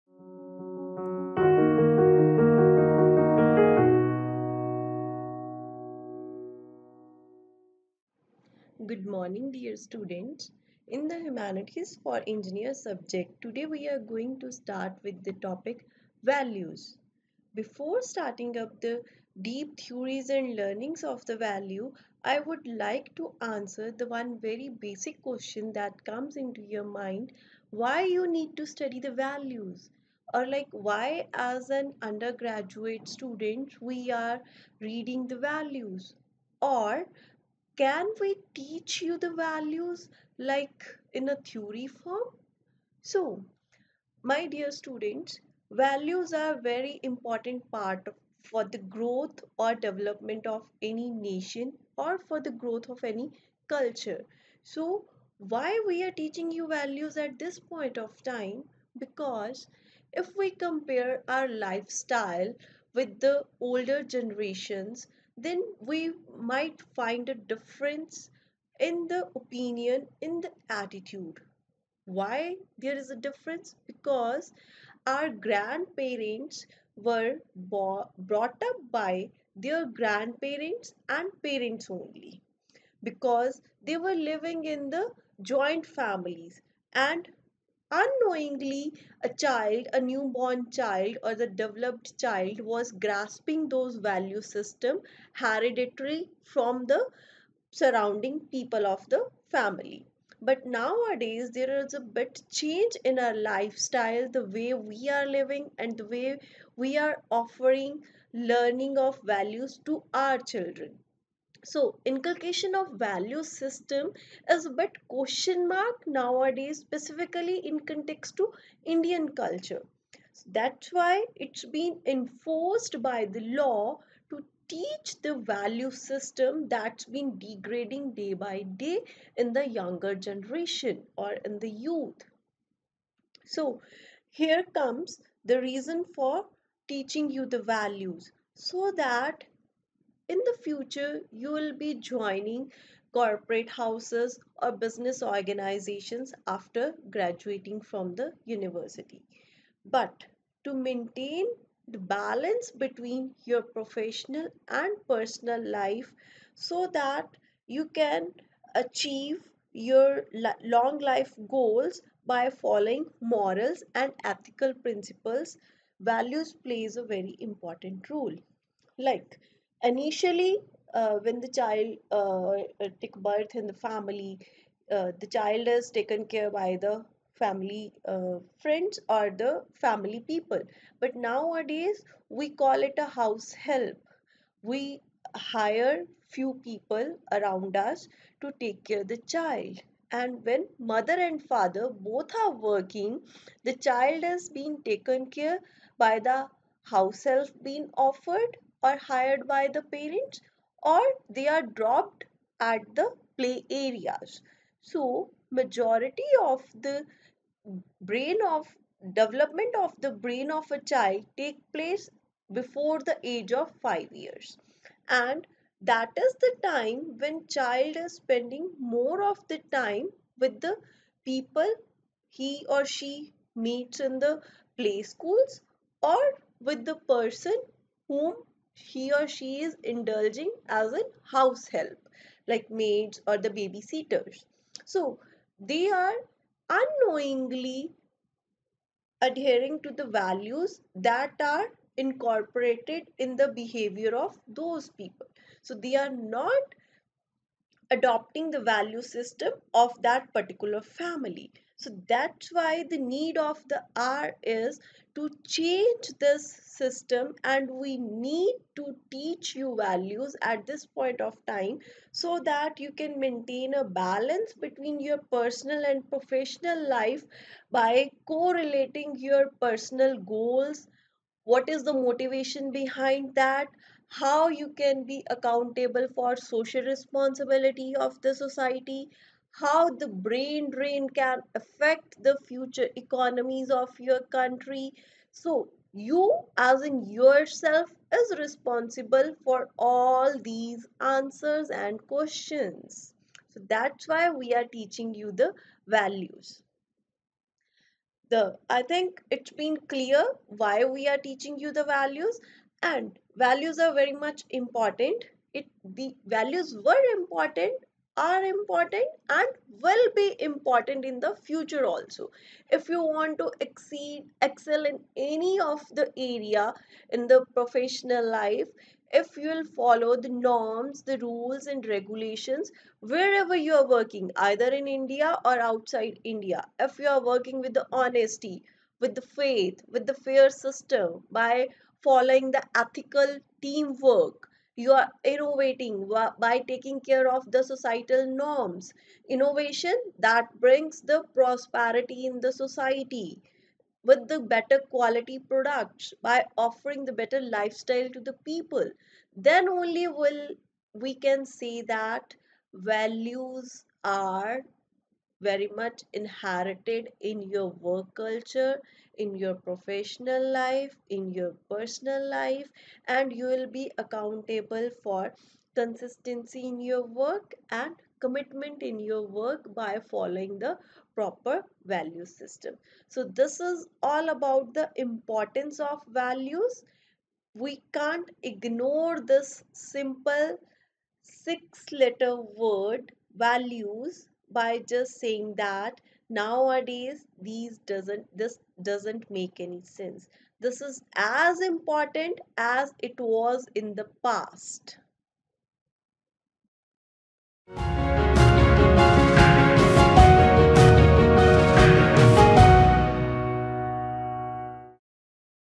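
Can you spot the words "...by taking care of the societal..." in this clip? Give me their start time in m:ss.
5:36.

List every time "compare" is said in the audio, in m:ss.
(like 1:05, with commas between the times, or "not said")
1:00.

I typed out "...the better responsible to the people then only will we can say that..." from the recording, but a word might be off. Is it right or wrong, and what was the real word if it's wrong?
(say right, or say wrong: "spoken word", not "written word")
wrong: "lifestyle", not "responsible".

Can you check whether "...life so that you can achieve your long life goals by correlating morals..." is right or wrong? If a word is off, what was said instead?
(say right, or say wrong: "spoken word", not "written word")
wrong: "following", not "correlating".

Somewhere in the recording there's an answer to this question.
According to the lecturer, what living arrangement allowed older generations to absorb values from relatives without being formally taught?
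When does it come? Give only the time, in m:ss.
1:25.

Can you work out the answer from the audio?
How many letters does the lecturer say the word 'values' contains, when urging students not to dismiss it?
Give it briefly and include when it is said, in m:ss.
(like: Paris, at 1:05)
6, at 6:21.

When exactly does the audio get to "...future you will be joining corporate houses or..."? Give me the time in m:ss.
2:20.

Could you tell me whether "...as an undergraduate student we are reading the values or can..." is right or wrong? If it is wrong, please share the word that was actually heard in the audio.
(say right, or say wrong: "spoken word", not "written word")
right.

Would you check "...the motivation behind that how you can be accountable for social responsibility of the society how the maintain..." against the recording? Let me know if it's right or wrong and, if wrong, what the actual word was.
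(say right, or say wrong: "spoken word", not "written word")
wrong: "brain", not "maintain".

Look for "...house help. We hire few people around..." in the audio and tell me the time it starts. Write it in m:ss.
3:03.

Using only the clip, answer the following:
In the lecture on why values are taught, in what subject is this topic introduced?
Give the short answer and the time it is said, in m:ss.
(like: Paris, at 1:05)
Humanities for Engineers, at 0:11.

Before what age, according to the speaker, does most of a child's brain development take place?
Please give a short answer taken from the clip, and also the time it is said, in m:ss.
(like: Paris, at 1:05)
5 years, at 3:33.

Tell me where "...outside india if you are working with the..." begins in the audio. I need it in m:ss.
5:25.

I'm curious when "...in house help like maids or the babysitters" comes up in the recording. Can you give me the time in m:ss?
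3:50.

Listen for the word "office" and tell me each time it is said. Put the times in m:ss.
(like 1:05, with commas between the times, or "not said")
not said.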